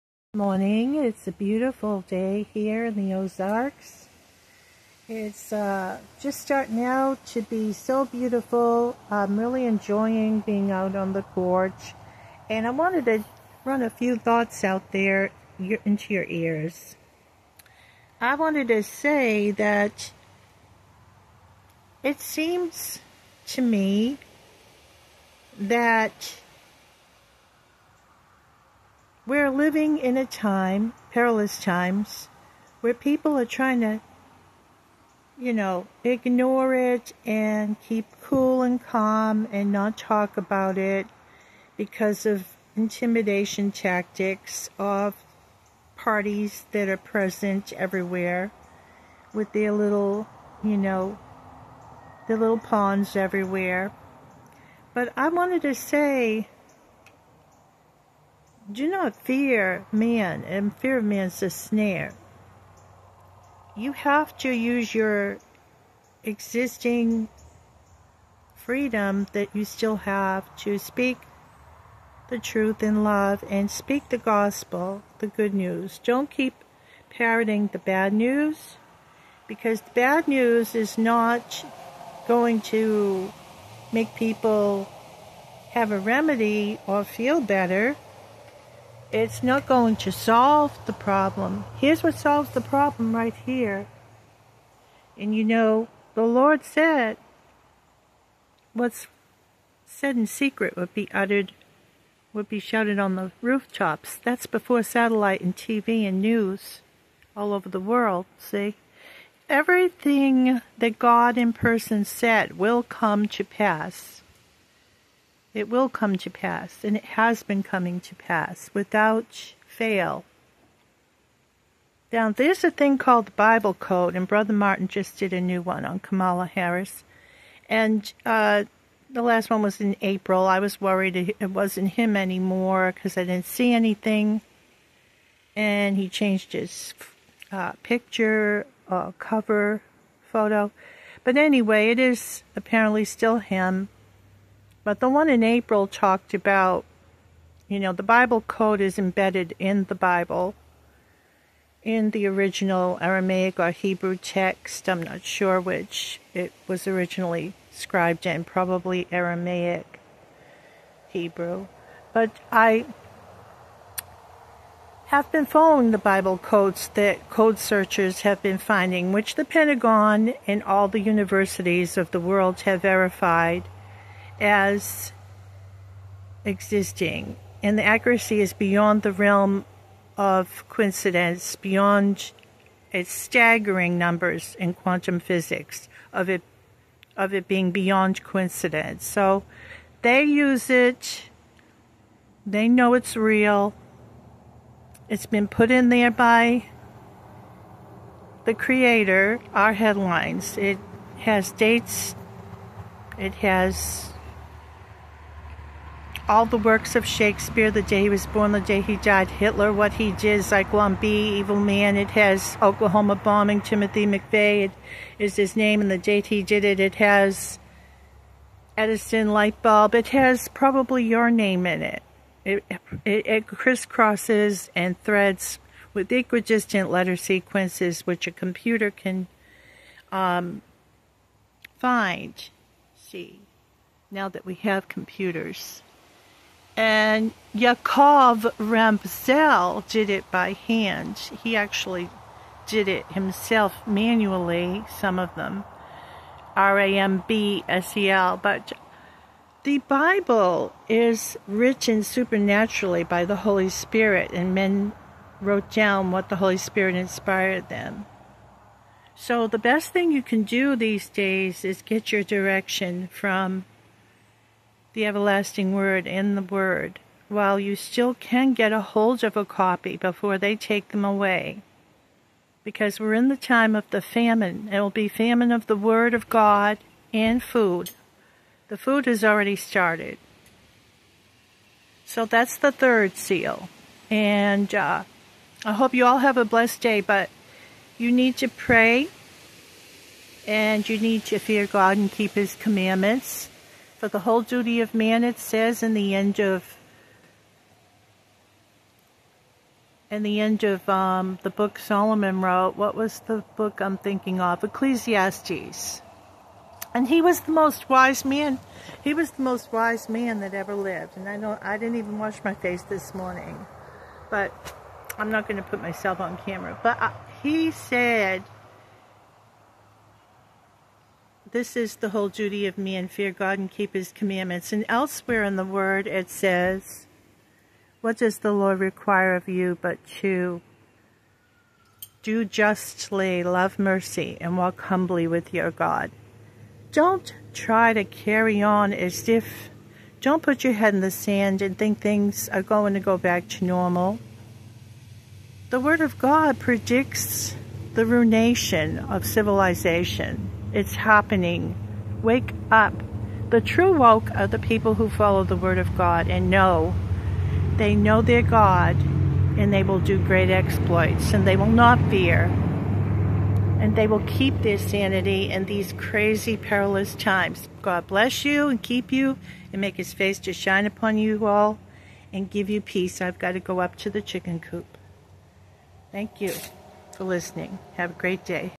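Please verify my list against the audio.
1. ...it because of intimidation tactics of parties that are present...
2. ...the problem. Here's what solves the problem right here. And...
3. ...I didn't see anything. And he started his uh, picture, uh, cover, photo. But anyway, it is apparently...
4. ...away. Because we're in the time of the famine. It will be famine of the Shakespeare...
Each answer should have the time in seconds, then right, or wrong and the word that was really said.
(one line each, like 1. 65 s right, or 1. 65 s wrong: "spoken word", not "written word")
1. 40 s right
2. 90 s right
3. 133 s wrong: "changed", not "started"
4. 271 s wrong: "Word", not "Shakespeare".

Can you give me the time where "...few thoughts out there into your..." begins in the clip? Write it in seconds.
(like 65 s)
13 s.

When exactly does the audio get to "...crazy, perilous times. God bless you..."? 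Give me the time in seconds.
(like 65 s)
365 s.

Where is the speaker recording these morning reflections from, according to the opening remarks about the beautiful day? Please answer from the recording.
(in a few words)
the Ozarks.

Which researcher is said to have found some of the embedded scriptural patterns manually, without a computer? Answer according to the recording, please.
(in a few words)
Yacov Rambsel.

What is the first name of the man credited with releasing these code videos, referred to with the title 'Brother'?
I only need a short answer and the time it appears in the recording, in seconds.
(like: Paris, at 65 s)
Martin, at 124 s.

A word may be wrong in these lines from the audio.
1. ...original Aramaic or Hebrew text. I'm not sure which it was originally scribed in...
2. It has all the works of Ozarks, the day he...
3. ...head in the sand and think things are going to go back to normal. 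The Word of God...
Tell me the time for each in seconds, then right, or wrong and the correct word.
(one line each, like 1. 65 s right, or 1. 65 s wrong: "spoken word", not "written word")
1. 152 s right
2. 203 s wrong: "Shakespeare", not "Ozarks"
3. 340 s right.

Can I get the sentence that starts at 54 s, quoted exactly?
But I wanted to say do not fear man, and fear of man's a snare.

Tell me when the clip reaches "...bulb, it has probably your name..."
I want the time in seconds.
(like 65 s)
219 s.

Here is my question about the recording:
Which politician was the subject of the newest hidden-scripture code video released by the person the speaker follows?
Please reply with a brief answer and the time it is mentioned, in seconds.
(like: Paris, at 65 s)
Kamala Harris, at 125 s.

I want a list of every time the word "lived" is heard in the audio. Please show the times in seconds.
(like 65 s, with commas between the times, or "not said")
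310 s.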